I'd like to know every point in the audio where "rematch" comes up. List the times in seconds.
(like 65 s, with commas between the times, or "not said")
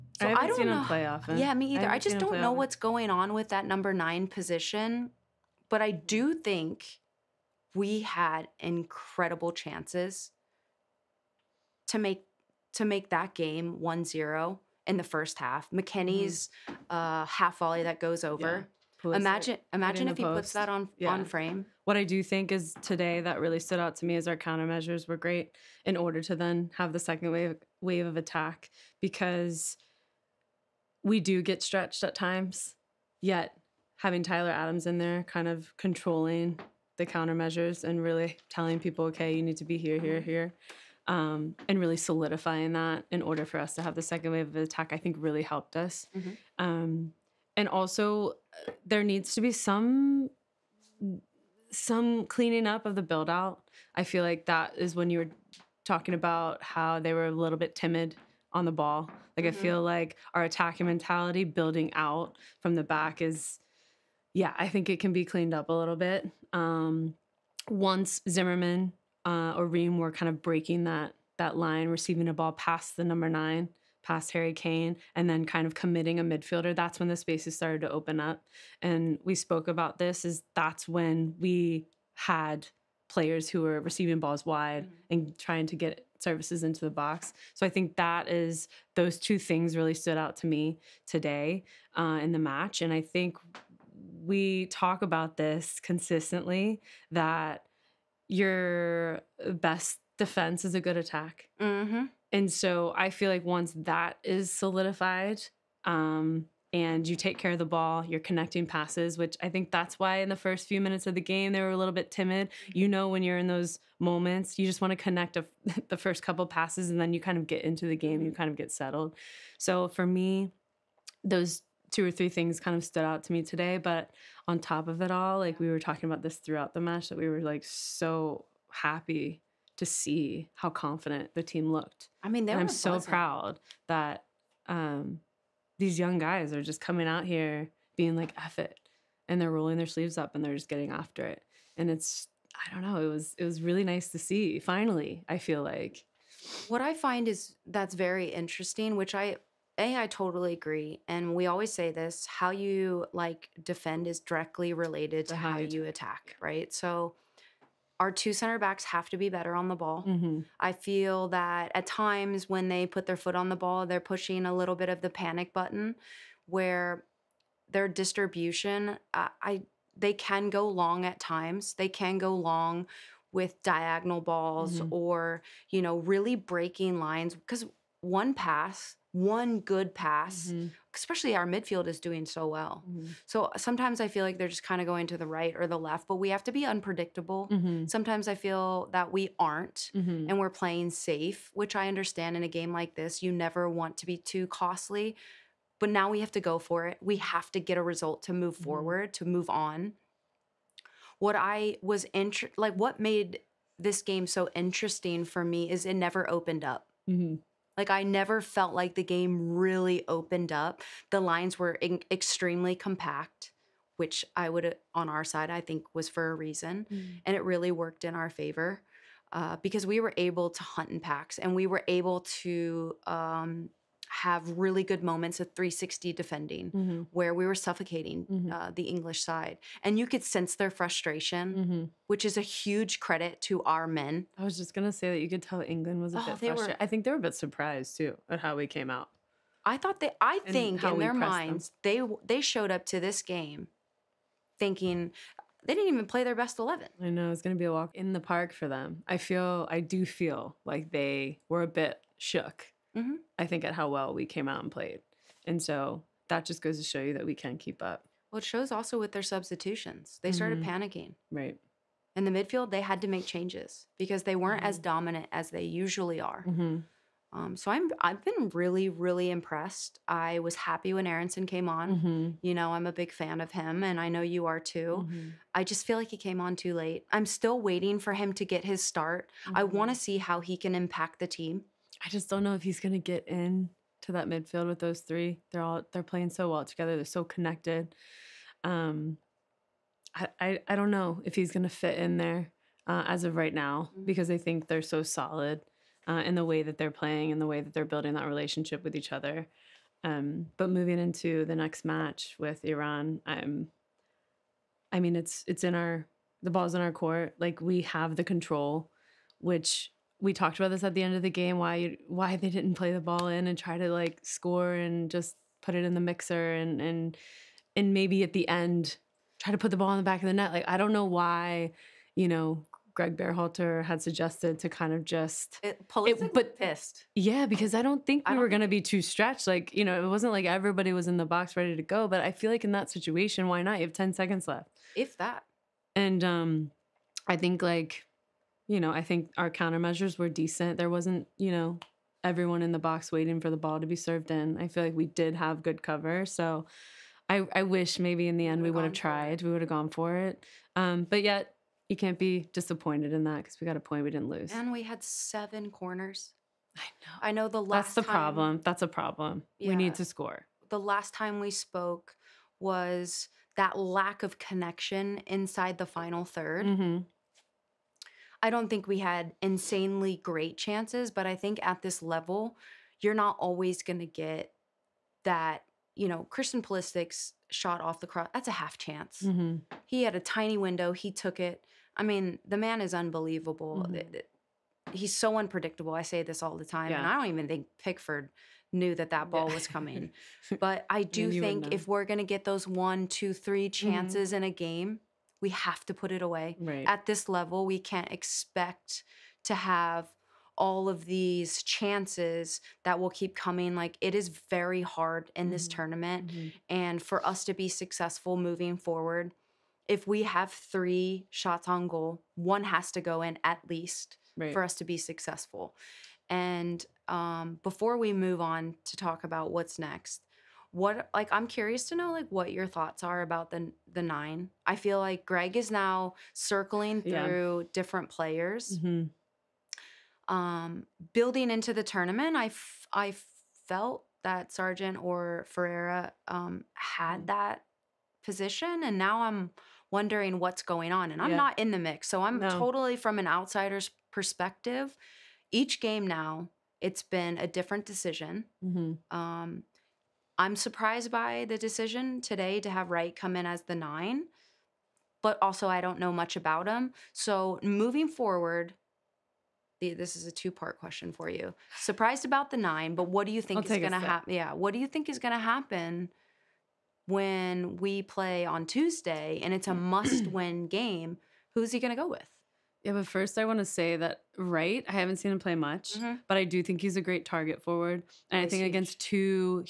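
not said.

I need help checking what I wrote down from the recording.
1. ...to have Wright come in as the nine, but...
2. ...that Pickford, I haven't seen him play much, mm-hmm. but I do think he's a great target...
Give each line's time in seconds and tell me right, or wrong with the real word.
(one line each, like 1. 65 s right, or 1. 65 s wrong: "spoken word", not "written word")
1. 452 s right
2. 473 s wrong: "Wright", not "Pickford".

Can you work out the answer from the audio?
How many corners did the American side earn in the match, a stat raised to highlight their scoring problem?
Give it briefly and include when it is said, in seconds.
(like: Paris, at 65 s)
7, at 355 s.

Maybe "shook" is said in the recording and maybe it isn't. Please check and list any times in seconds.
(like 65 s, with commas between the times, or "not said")
252 s.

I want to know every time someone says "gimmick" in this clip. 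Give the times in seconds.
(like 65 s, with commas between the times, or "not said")
not said.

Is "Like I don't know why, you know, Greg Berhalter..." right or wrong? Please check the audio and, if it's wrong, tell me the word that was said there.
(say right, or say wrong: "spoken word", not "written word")
right.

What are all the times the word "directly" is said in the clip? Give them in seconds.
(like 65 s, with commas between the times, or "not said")
154 s.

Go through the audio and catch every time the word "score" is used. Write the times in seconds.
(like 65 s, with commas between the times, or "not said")
314 s, 360 s.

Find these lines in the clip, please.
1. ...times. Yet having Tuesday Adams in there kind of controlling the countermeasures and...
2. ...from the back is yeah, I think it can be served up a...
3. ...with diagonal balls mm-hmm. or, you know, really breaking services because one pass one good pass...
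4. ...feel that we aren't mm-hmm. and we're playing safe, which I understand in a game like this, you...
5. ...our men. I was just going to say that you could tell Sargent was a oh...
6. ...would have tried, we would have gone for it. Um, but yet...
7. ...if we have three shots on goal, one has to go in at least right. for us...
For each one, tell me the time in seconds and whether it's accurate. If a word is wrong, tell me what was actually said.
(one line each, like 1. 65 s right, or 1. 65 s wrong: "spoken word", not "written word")
1. 32 s wrong: "Tyler", not "Tuesday"
2. 62 s wrong: "cleaned", not "served"
3. 173 s wrong: "lines", not "services"
4. 188 s right
5. 233 s wrong: "England", not "Sargent"
6. 348 s right
7. 409 s right.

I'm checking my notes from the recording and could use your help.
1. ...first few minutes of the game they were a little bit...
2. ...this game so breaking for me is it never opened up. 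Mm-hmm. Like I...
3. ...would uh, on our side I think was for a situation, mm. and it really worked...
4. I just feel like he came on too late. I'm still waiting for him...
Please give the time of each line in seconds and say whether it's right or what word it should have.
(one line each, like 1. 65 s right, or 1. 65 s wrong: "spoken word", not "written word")
1. 110 s right
2. 203 s wrong: "interesting", not "breaking"
3. 214 s wrong: "reason", not "situation"
4. 275 s right.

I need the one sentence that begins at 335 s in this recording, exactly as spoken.
And um, I think like you know, I think our countermeasures were decent.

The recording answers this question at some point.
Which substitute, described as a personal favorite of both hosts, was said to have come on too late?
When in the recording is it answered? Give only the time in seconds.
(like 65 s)
271 s.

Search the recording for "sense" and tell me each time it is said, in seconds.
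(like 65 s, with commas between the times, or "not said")
230 s.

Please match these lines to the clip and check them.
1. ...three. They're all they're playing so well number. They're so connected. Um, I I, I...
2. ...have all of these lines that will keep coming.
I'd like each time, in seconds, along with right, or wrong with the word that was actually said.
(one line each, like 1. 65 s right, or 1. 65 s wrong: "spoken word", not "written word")
1. 284 s wrong: "together", not "number"
2. 399 s wrong: "chances", not "lines".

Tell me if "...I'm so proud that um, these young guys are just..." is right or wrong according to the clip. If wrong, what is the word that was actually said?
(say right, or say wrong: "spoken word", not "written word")
right.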